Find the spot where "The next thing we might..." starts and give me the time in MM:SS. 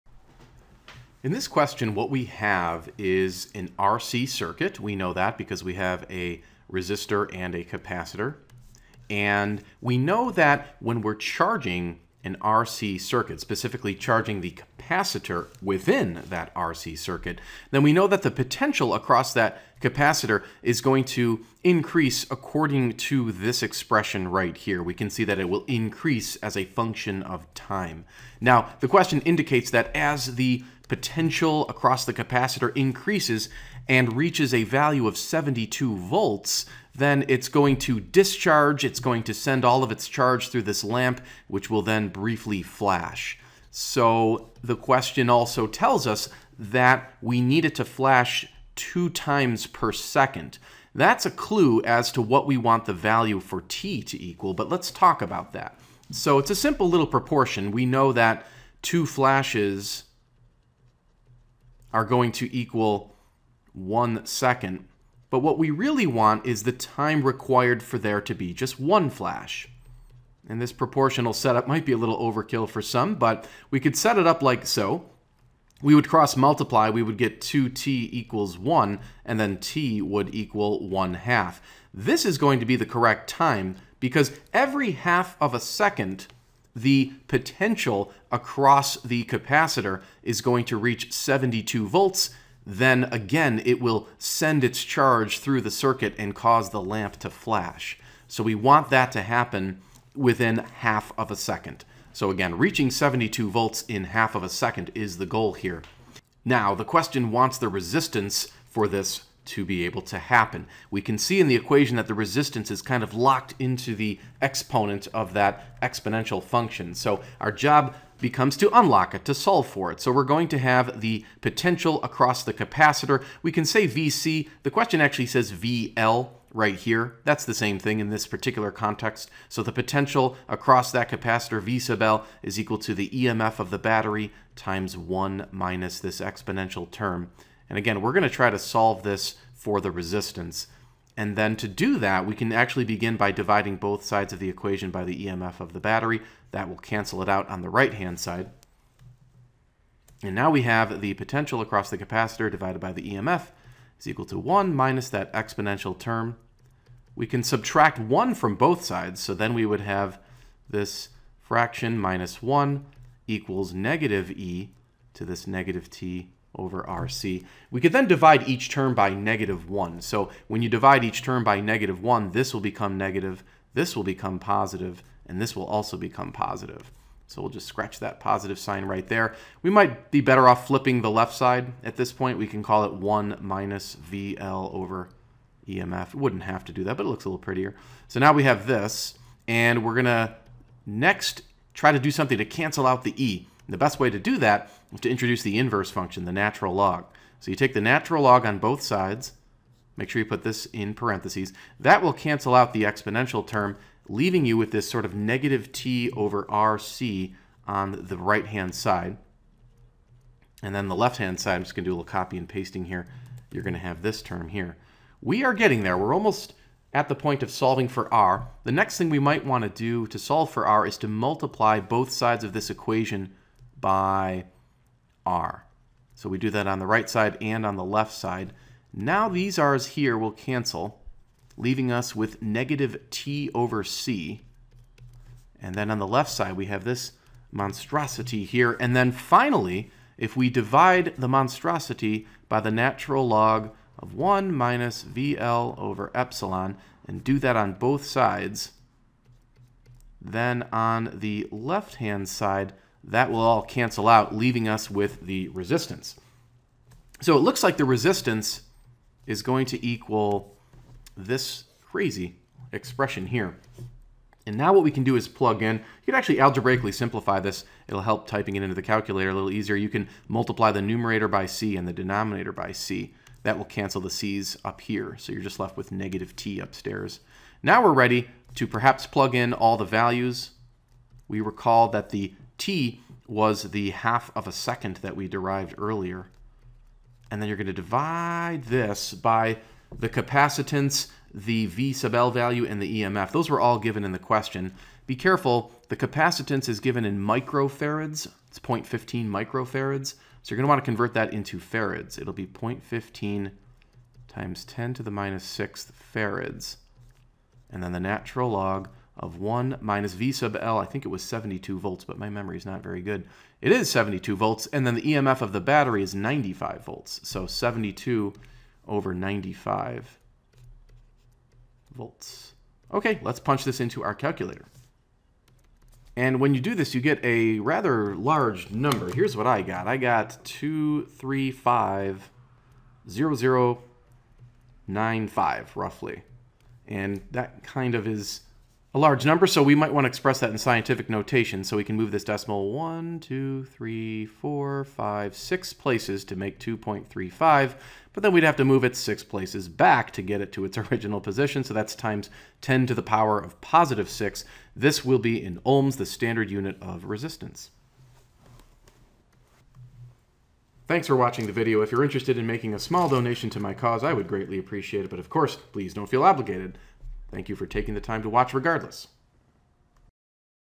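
03:38.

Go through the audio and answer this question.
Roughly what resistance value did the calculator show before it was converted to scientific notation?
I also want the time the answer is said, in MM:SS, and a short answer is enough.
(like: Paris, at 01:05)
2350095, at 05:30.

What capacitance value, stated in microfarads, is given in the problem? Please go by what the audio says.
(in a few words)
0.15 microfarads.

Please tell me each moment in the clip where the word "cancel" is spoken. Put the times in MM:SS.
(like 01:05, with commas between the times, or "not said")
02:26, 03:12, 03:22, 03:50, 04:13, 04:33.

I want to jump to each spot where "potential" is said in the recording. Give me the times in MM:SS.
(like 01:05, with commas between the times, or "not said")
00:18, 00:30, 01:27, 02:01, 02:09, 02:31.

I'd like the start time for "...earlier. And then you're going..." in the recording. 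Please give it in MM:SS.
04:45.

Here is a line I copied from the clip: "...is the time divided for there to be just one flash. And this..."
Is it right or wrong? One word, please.
wrong.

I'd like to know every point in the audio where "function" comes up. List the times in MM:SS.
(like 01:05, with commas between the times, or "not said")
00:26, 01:56, 03:15.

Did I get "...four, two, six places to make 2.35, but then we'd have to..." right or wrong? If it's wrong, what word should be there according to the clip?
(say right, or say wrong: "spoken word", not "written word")
wrong: "five", not "two".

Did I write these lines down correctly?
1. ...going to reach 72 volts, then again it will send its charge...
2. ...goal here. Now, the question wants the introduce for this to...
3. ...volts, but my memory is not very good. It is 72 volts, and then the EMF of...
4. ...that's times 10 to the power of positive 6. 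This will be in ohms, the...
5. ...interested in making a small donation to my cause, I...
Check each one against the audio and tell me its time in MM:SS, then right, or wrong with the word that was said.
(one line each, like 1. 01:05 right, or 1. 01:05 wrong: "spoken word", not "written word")
1. 01:30 right
2. 01:45 wrong: "resistance", not "introduce"
3. 05:11 right
4. 05:51 right
5. 06:02 right.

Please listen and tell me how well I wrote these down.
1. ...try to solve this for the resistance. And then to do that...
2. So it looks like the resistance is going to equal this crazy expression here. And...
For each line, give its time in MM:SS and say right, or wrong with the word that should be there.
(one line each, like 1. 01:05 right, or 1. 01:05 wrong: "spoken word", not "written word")
1. 02:18 right
2. 04:17 right.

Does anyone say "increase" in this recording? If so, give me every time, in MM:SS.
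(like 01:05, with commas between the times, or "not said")
00:21, 00:25, 00:32.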